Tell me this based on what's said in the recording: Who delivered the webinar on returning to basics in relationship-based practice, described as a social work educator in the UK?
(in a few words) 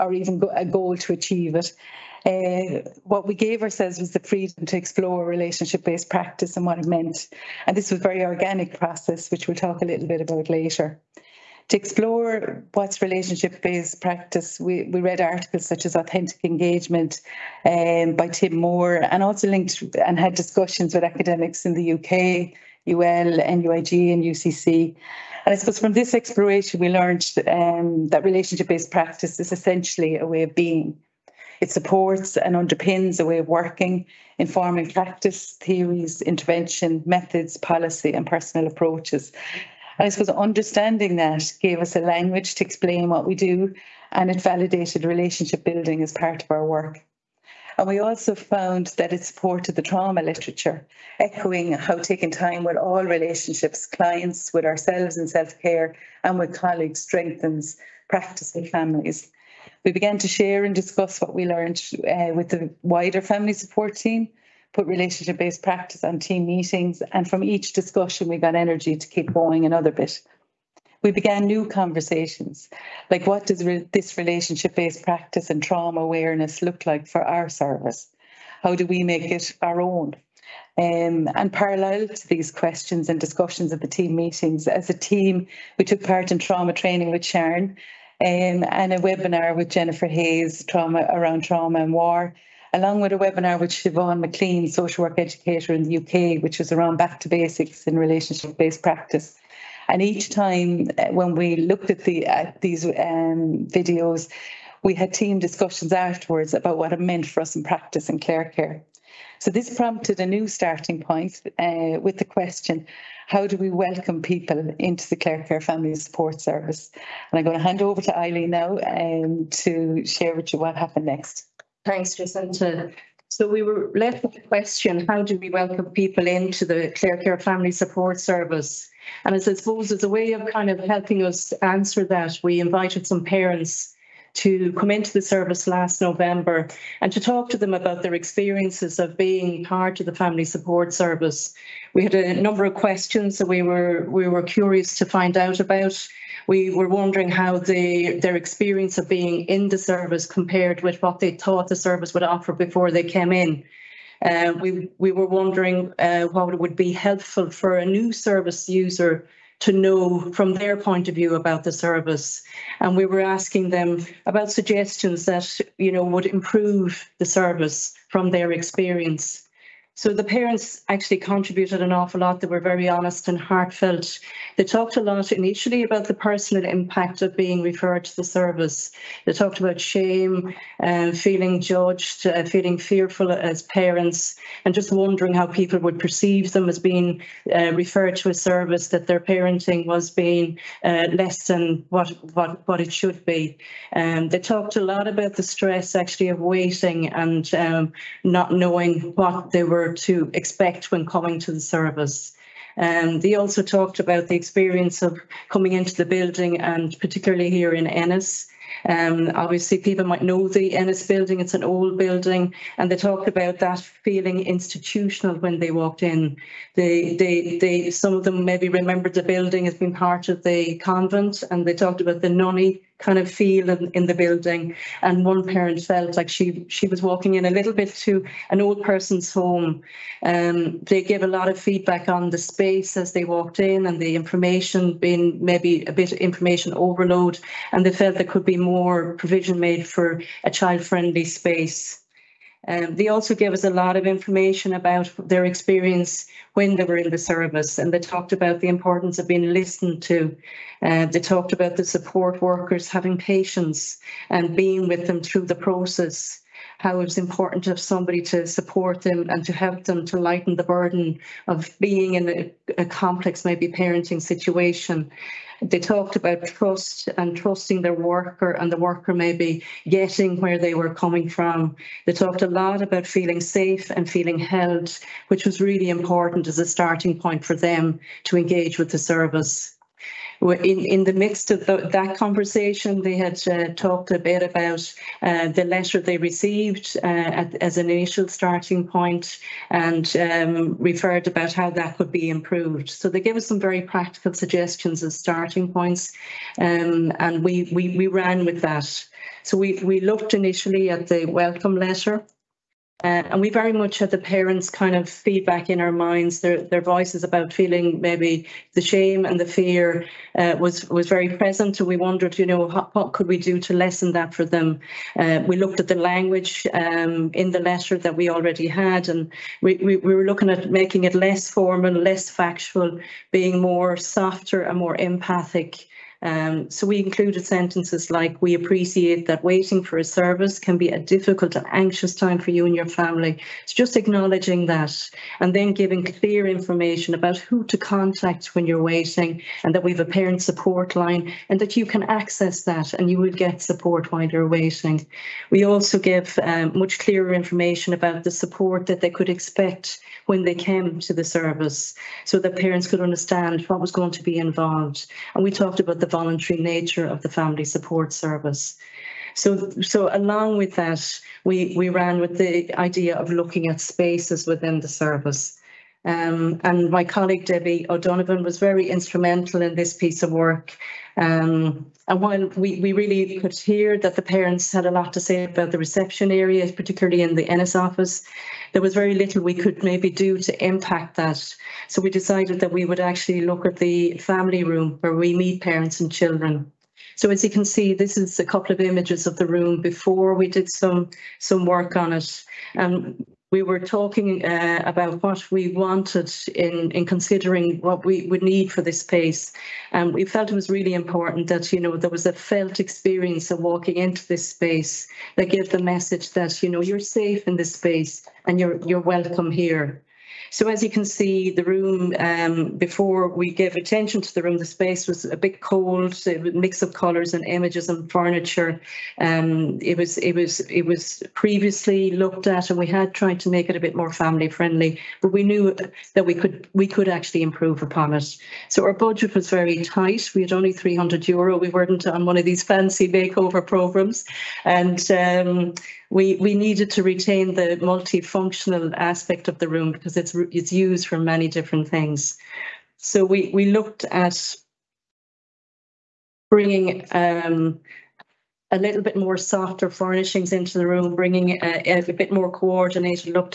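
Siobhan Maclean.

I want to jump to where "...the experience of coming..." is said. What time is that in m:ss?
3:24.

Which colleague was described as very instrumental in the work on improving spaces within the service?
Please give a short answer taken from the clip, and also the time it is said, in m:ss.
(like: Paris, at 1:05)
Debbie O'Donovan, at 6:07.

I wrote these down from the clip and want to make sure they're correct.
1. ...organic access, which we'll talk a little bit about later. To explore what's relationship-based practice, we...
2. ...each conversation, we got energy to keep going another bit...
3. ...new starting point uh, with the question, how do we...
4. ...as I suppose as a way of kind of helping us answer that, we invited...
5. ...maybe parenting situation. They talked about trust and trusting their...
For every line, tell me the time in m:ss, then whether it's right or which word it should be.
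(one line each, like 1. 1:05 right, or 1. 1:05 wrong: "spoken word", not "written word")
1. 0:08 wrong: "process", not "access"
2. 1:07 wrong: "discussion", not "conversation"
3. 1:50 right
4. 2:09 right
5. 4:23 right.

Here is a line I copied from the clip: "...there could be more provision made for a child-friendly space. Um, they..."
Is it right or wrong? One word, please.
right.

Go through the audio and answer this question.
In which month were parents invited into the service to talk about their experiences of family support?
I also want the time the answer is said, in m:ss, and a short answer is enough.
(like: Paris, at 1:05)
November, at 2:16.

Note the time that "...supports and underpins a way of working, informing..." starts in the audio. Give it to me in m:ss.
0:31.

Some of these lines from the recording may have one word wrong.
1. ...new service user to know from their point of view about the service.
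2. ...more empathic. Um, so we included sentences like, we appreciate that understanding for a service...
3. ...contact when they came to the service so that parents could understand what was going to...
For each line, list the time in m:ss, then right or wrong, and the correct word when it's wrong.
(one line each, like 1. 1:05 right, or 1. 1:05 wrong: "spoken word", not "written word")
1. 2:37 right
2. 5:24 wrong: "waiting", not "understanding"
3. 5:49 wrong: "expect", not "contact".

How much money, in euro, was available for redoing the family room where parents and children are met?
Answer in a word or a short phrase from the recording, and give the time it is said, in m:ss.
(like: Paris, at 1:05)
300 euro, at 7:10.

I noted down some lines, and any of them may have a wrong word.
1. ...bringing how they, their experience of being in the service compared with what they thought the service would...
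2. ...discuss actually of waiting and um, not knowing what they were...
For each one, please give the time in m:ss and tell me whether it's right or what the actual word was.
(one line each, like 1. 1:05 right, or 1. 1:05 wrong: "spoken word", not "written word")
1. 2:26 wrong: "wondering", not "bringing"
2. 3:15 wrong: "stress", not "discuss".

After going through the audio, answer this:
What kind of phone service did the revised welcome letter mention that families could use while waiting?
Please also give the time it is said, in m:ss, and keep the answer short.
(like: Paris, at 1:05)
parent support line, at 5:40.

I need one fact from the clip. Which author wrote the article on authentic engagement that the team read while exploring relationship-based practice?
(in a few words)
Tim Moore.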